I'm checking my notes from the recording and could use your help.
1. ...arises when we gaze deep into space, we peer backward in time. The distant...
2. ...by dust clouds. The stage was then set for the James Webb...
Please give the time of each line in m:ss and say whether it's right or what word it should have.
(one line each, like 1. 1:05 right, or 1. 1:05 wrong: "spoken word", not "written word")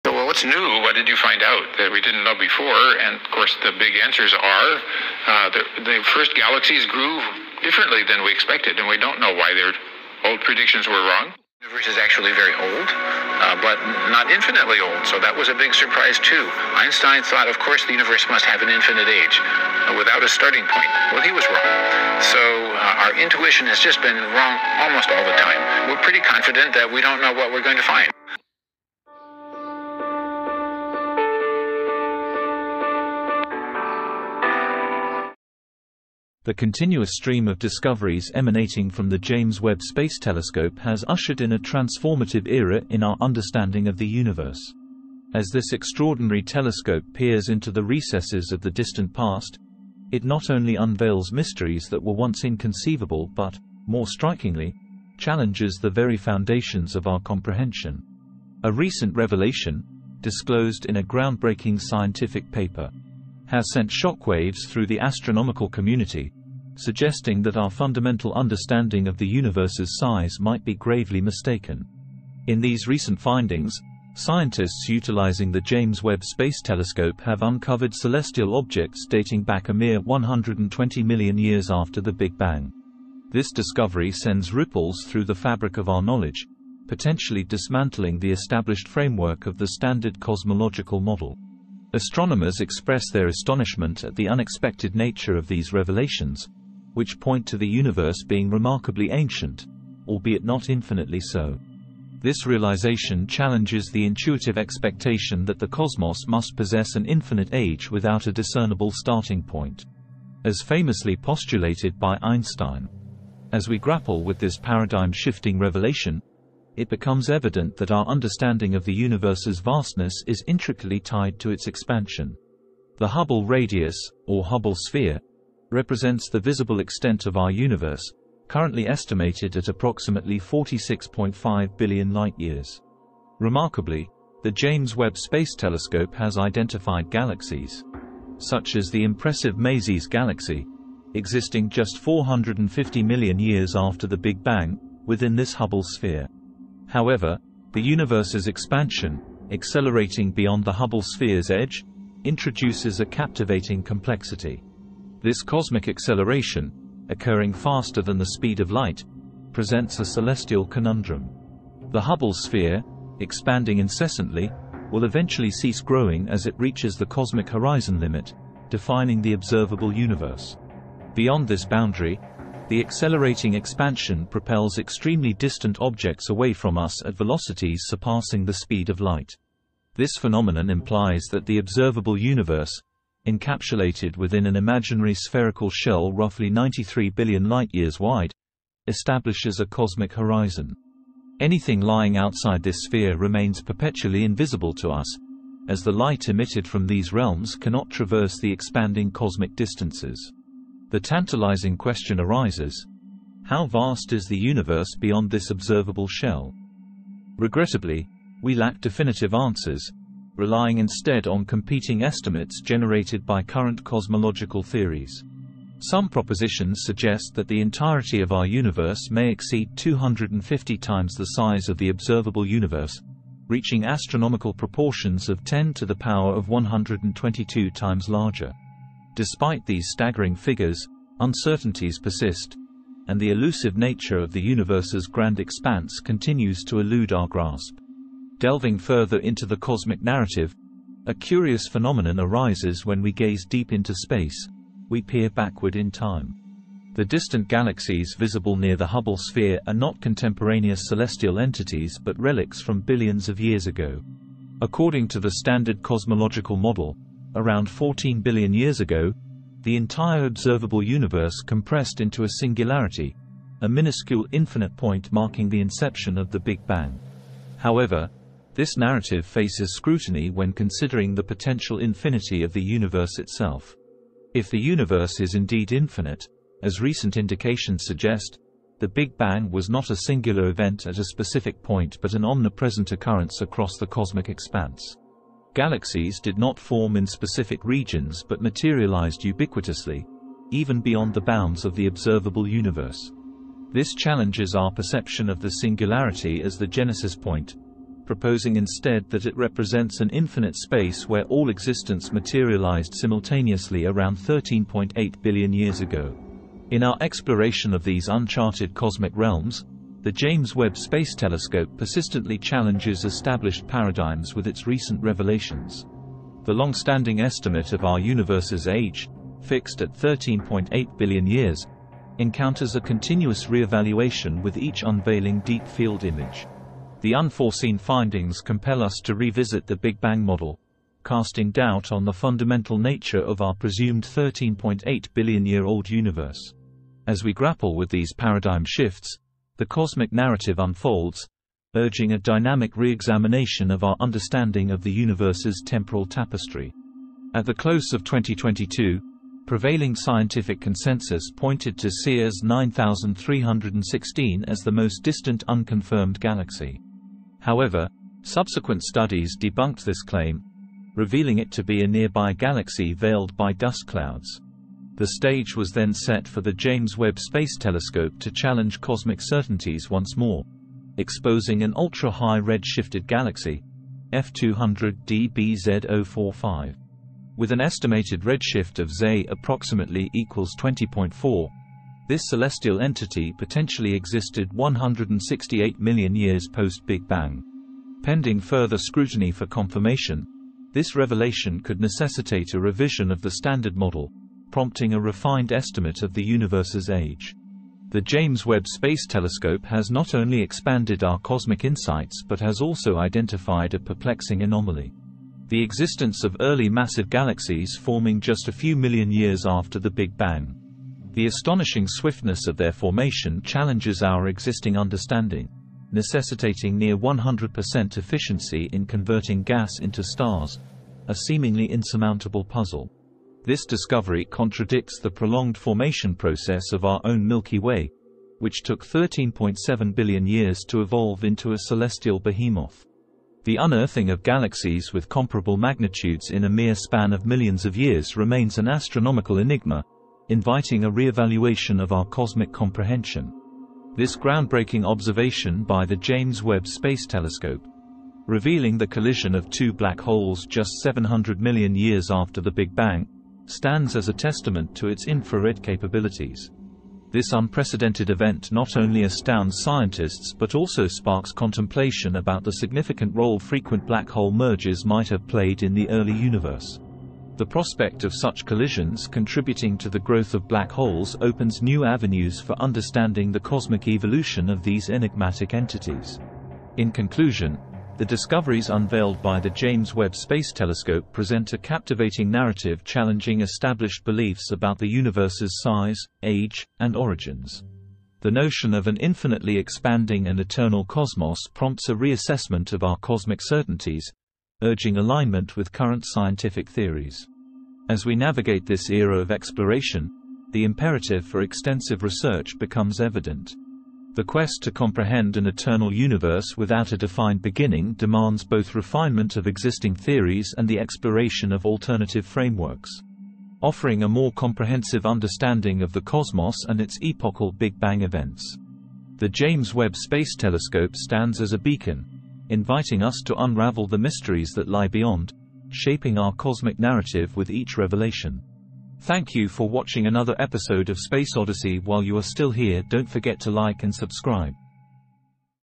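1. 4:02 right
2. 6:03 right.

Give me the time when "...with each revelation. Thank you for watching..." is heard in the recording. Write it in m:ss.
8:47.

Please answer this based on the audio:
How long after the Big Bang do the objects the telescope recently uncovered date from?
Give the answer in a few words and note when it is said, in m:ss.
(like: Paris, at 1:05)
120 million years, at 1:19.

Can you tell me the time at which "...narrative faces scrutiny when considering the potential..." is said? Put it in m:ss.
4:28.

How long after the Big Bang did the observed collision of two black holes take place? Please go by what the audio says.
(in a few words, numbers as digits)
700 million years.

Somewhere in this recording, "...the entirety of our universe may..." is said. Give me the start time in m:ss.
3:37.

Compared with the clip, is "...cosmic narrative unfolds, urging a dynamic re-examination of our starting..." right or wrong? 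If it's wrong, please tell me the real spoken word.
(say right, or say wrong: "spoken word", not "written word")
wrong: "understanding", not "starting".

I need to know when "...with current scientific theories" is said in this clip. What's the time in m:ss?
8:15.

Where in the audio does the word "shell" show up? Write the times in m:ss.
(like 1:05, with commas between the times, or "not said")
3:05, 3:26.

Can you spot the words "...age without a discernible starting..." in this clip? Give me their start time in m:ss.
1:47.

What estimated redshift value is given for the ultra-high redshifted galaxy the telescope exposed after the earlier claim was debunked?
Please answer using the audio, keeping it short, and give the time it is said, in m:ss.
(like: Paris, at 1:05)
20.4, at 6:20.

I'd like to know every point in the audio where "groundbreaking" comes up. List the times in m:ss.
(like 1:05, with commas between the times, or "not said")
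1:01, 7:24.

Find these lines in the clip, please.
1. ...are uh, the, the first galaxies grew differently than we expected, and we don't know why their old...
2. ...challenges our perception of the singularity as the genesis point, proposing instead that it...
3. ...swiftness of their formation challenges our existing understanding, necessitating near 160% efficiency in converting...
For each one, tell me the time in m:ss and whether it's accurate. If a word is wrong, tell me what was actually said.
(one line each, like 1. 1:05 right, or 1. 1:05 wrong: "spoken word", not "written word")
1. 0:04 right
2. 4:53 right
3. 6:51 wrong: "100", not "160".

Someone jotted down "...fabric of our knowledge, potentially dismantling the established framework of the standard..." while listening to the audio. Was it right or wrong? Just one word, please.
right.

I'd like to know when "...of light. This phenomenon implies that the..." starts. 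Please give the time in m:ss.
2:58.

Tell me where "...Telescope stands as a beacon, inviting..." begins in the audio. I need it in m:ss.
8:40.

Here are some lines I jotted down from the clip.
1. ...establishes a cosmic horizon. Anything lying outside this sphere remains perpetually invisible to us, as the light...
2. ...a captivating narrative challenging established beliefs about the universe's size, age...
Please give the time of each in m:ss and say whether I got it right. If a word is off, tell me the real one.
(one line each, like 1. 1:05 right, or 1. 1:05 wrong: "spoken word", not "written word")
1. 3:08 right
2. 8:01 right.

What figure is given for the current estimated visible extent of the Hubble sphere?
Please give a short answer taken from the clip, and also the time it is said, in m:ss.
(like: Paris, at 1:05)
46.5 billion light-years, at 2:10.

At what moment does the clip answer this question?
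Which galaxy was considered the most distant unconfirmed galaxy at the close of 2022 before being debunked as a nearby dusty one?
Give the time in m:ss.
5:51.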